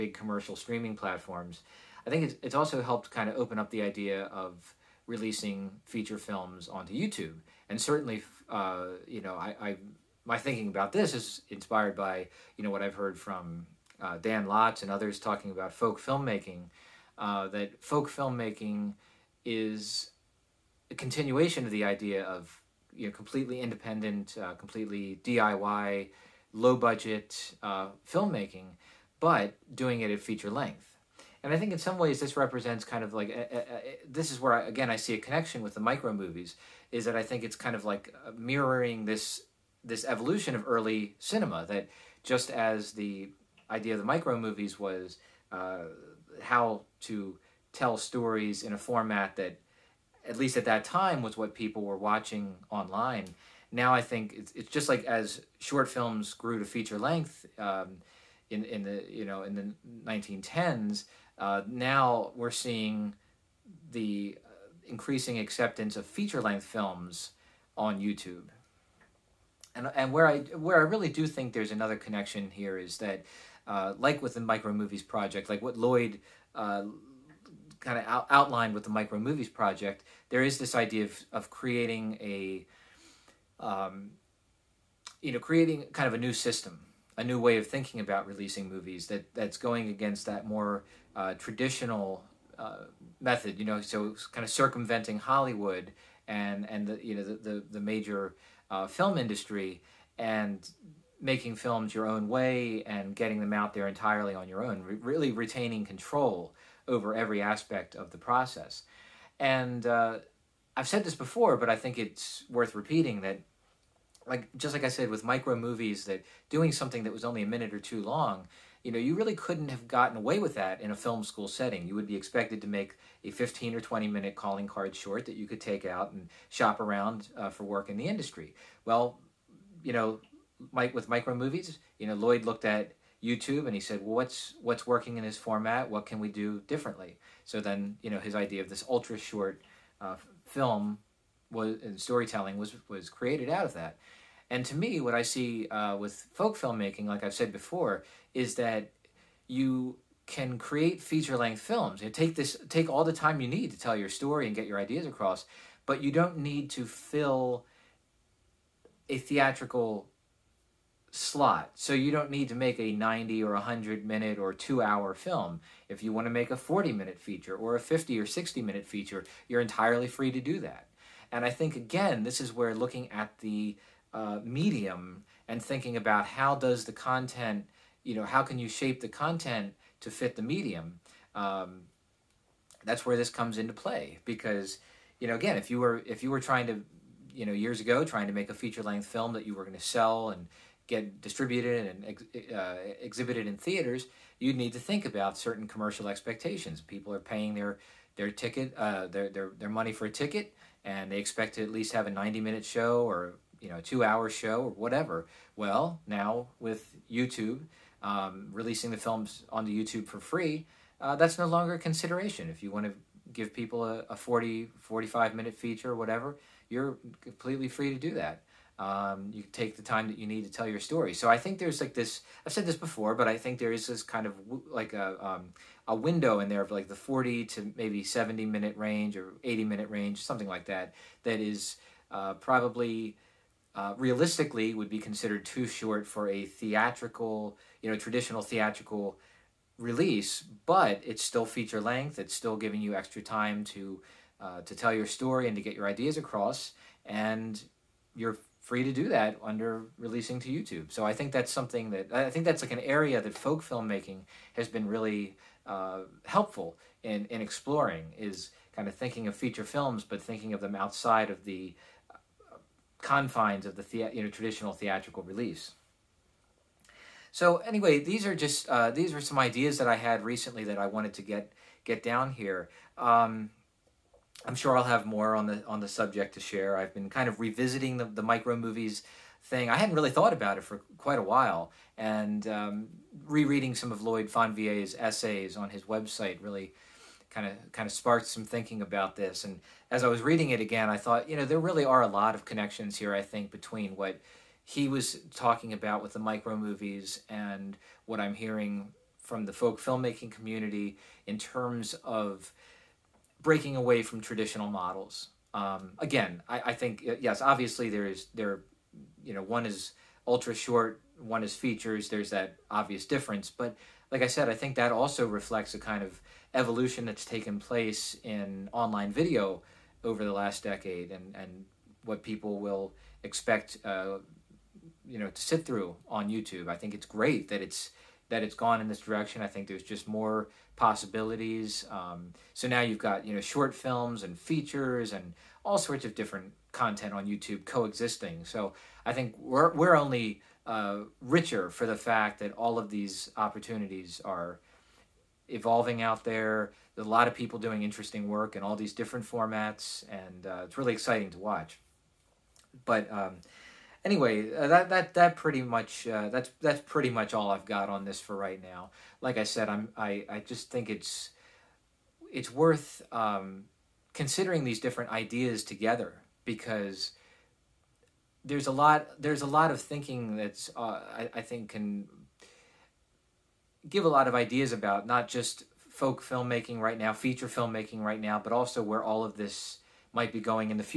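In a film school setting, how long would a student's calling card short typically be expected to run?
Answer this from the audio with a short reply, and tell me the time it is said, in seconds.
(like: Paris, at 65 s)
15 or 20 minutes, at 123 s.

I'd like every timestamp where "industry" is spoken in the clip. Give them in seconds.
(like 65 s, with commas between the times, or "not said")
99 s, 128 s.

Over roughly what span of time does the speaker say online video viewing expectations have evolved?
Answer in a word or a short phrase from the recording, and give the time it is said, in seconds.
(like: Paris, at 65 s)
the last decade, at 320 s.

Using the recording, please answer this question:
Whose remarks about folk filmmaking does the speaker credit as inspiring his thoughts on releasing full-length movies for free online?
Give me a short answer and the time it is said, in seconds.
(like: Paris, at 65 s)
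Dan Lotz, at 14 s.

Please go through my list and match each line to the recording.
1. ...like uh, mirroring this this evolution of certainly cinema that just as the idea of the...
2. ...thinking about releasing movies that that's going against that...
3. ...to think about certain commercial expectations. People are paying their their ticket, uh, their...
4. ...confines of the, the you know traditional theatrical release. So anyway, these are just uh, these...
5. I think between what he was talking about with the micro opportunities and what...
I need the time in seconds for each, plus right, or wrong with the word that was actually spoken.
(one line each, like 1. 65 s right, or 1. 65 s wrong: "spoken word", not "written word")
1. 37 s wrong: "early", not "certainly"
2. 87 s right
3. 194 s right
4. 263 s right
5. 293 s wrong: "movies", not "opportunities".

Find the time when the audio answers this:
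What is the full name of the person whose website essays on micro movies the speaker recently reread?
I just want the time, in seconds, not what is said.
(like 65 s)
284 s.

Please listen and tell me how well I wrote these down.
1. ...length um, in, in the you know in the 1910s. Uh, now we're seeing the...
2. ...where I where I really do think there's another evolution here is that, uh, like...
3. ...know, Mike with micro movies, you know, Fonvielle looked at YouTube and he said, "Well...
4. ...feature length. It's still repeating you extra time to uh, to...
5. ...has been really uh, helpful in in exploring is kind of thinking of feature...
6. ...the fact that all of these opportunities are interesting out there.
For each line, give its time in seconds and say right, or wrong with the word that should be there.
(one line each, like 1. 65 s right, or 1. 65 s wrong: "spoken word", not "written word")
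1. 56 s right
2. 70 s wrong: "connection", not "evolution"
3. 129 s wrong: "Lloyd", not "Fonvielle"
4. 241 s wrong: "giving", not "repeating"
5. 254 s right
6. 341 s wrong: "evolving", not "interesting".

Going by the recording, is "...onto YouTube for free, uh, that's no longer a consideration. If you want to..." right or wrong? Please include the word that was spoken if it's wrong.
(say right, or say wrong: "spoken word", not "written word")
right.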